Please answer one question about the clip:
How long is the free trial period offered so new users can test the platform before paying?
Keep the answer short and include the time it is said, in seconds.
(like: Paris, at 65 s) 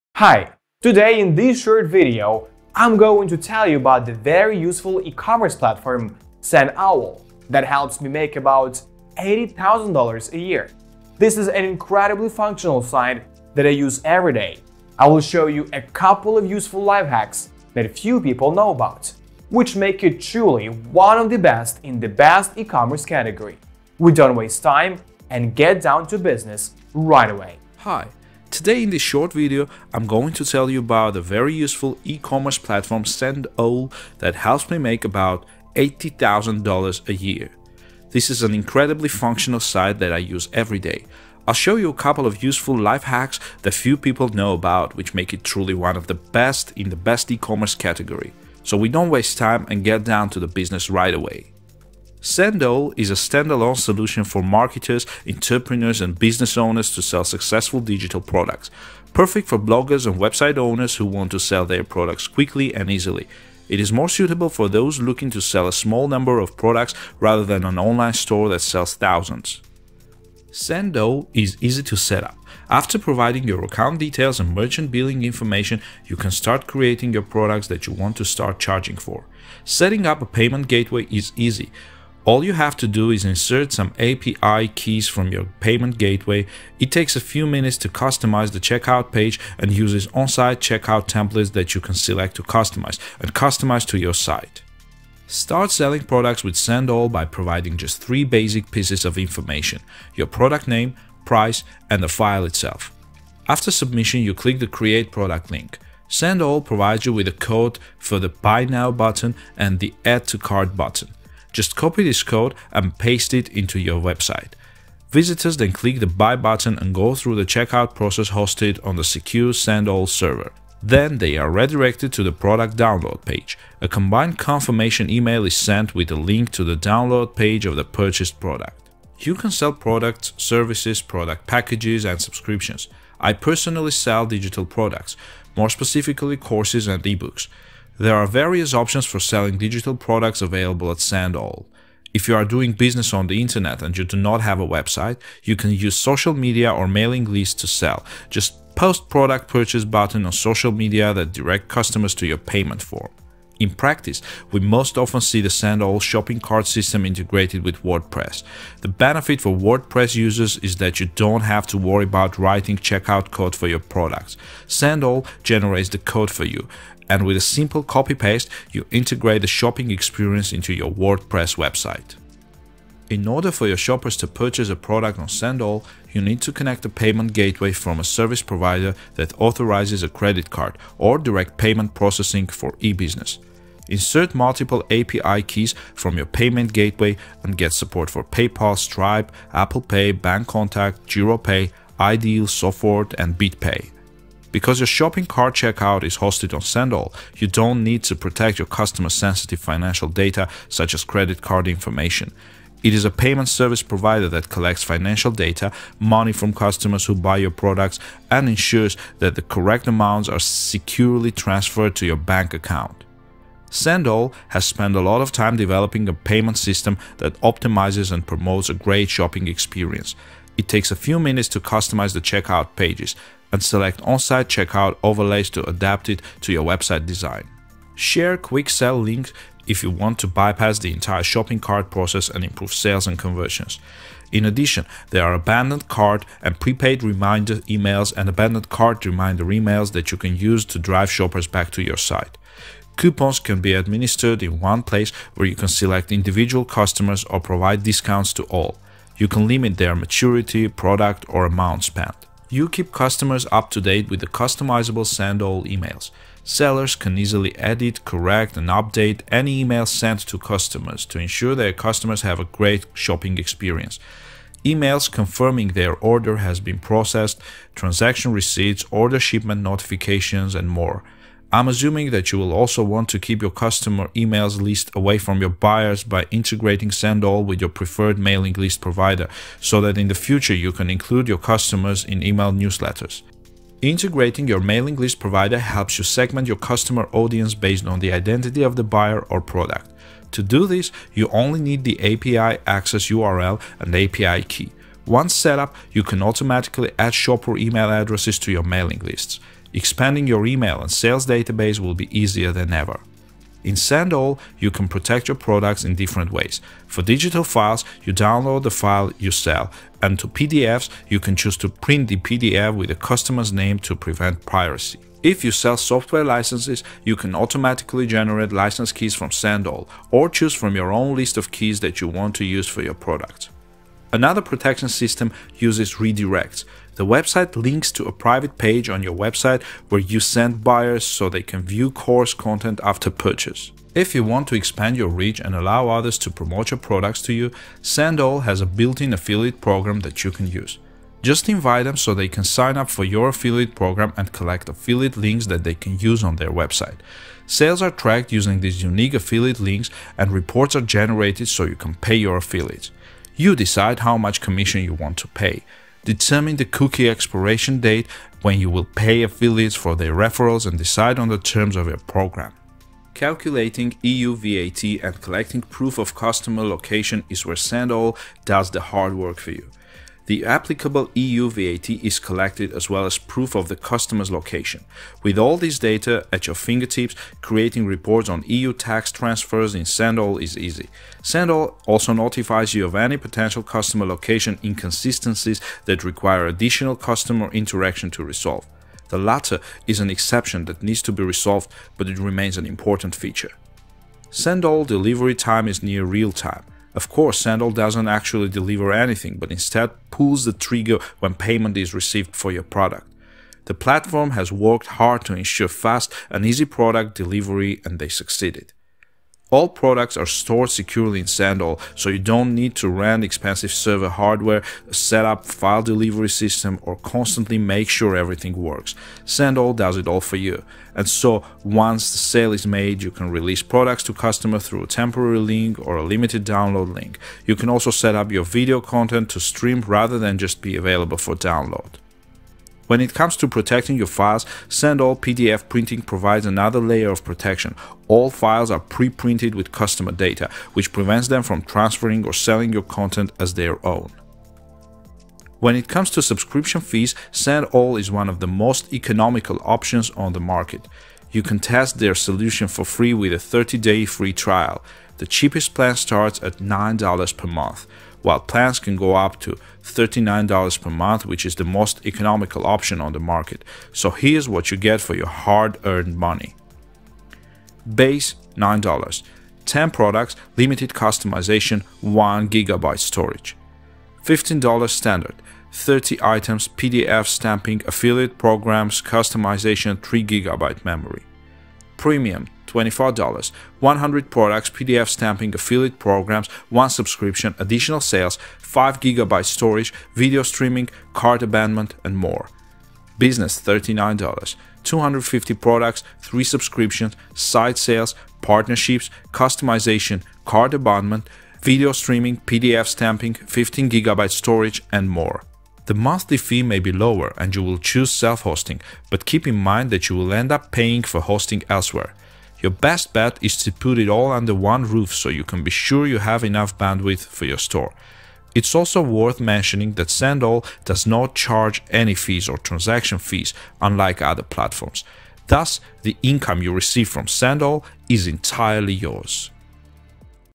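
30 days, at 453 s.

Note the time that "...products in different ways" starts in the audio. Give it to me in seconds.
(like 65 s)
305 s.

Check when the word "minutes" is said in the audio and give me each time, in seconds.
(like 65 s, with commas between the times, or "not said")
87 s, 221 s.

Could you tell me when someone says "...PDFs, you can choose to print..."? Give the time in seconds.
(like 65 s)
310 s.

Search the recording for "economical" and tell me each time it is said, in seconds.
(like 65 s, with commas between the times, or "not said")
448 s, 462 s.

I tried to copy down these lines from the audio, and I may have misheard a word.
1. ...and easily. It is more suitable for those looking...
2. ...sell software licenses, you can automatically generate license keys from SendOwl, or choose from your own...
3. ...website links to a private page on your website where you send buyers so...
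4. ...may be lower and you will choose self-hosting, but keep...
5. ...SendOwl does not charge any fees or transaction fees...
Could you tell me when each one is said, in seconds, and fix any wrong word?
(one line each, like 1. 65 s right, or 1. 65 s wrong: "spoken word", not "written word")
1. 62 s right
2. 315 s right
3. 327 s right
4. 506 s right
5. 520 s right.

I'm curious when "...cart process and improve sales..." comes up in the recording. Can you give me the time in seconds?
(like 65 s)
231 s.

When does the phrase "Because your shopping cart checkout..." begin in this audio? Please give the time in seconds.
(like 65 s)
194 s.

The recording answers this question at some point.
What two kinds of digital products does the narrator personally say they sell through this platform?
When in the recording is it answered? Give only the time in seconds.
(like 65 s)
136 s.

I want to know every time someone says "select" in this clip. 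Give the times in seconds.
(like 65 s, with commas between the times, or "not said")
91 s, 223 s, 245 s.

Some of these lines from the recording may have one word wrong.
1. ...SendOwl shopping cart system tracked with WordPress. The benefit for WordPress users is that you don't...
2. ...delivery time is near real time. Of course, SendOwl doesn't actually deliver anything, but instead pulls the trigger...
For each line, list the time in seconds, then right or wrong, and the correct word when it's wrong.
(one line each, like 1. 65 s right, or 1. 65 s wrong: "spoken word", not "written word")
1. 155 s wrong: "integrated", not "tracked"
2. 394 s right.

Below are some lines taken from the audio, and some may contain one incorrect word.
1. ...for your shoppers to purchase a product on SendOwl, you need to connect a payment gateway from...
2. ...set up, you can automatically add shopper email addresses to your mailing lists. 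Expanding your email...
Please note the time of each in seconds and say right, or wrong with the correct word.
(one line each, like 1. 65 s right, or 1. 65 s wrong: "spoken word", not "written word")
1. 173 s right
2. 295 s right.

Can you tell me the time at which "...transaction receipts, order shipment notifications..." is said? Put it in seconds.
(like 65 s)
267 s.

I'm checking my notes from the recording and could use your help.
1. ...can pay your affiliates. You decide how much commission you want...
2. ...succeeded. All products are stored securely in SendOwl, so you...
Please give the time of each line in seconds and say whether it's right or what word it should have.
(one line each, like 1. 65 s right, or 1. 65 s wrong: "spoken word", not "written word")
1. 351 s right
2. 408 s right.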